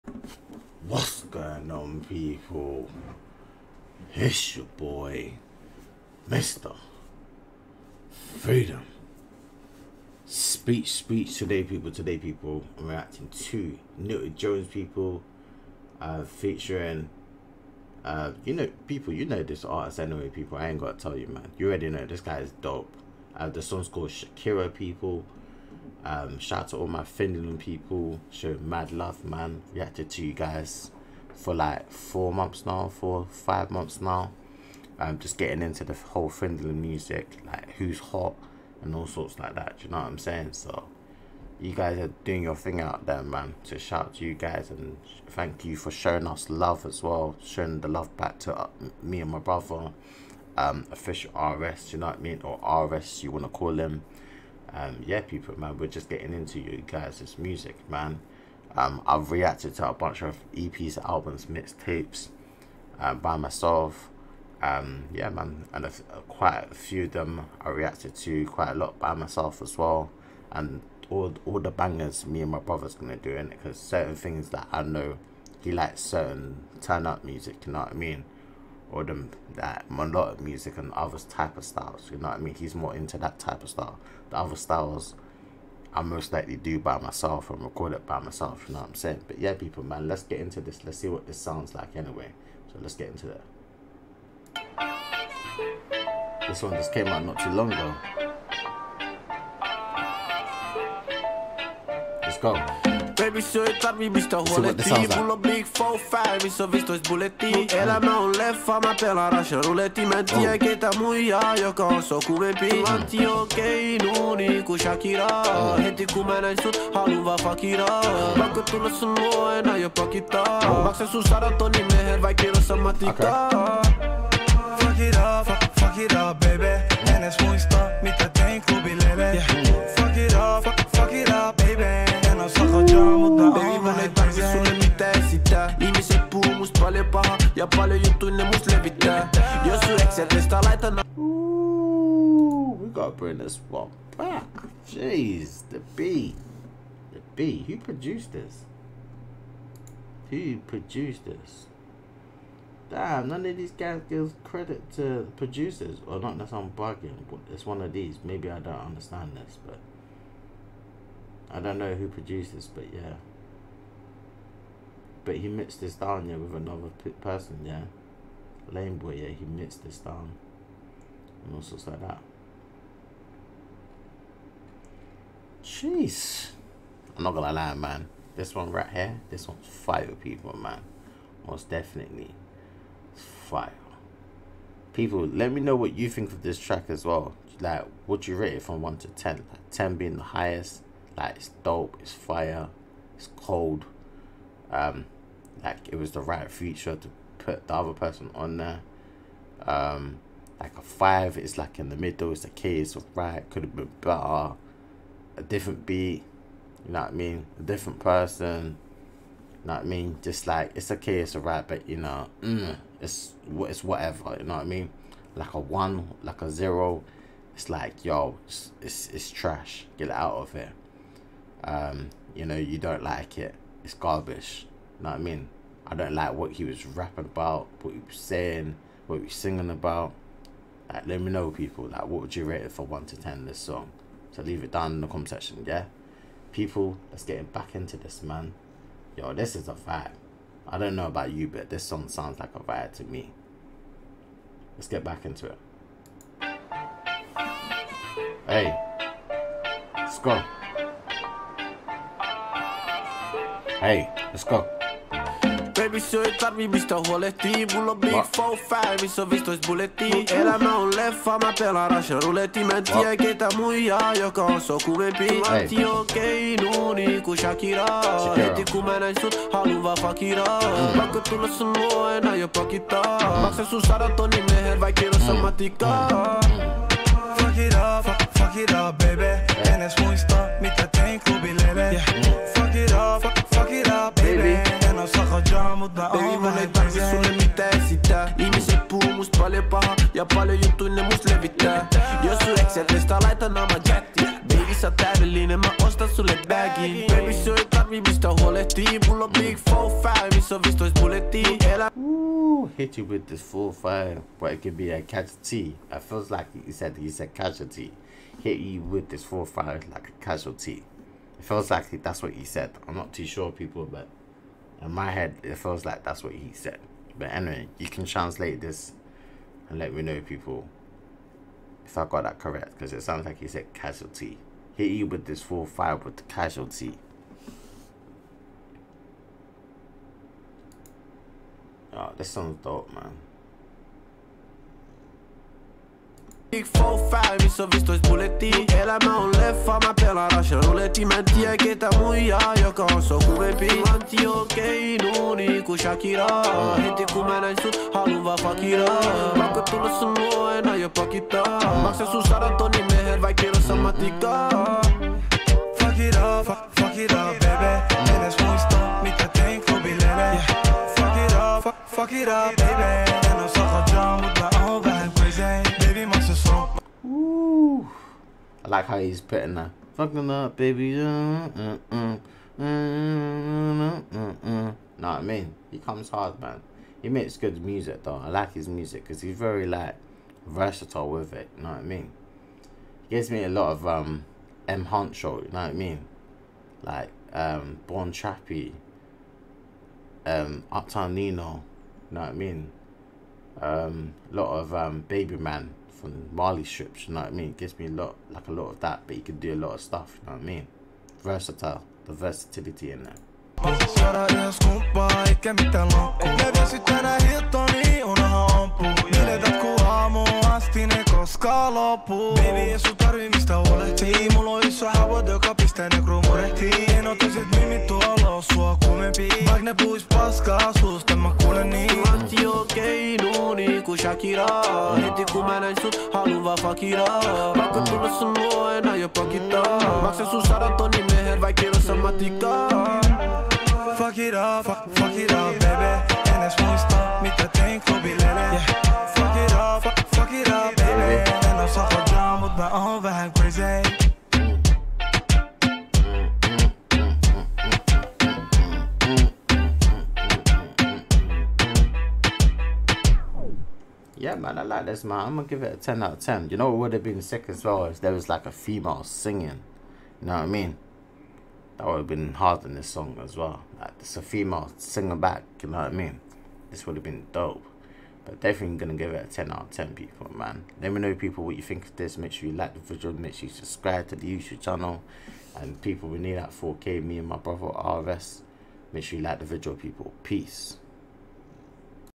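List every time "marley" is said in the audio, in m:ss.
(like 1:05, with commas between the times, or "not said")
6:36.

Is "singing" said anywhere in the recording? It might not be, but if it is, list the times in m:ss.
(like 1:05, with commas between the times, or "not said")
3:49, 7:39, 7:44.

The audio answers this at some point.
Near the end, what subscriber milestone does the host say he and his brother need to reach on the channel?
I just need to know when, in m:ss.
7:56.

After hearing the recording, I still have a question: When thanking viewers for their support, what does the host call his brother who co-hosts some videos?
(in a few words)
Official RS.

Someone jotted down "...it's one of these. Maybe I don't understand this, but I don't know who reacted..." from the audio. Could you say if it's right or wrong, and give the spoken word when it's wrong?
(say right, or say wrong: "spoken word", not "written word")
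wrong: "produced", not "reacted".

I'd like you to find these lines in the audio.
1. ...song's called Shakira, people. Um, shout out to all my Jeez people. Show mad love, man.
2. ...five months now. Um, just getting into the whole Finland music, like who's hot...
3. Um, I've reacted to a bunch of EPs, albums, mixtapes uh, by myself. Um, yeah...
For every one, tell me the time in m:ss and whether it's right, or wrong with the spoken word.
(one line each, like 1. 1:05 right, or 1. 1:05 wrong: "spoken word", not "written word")
1. 0:23 wrong: "Finland", not "Jeez"
2. 0:33 right
3. 0:58 right.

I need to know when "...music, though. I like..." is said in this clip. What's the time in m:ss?
6:17.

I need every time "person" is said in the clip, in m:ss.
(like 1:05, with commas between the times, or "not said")
2:47, 3:17, 3:27.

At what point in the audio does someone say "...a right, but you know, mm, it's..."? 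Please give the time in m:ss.
3:31.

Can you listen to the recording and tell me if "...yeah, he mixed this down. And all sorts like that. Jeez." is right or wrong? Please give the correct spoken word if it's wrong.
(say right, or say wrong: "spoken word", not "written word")
right.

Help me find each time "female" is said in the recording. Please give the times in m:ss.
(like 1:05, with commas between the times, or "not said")
7:38, 7:44.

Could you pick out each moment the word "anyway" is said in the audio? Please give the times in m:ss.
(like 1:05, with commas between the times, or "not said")
0:19, 1:31, 5:17.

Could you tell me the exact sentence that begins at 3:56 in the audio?
People, let's get back into this, man.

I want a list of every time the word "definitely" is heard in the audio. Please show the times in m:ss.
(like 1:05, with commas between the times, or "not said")
3:01, 7:48.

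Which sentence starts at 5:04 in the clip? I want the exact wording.
but it could be a casualty.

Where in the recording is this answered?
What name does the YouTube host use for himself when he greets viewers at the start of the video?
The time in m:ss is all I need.
0:06.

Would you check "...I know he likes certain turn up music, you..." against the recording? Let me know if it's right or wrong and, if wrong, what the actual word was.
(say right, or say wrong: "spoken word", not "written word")
right.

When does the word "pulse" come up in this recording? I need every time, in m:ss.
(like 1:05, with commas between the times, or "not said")
not said.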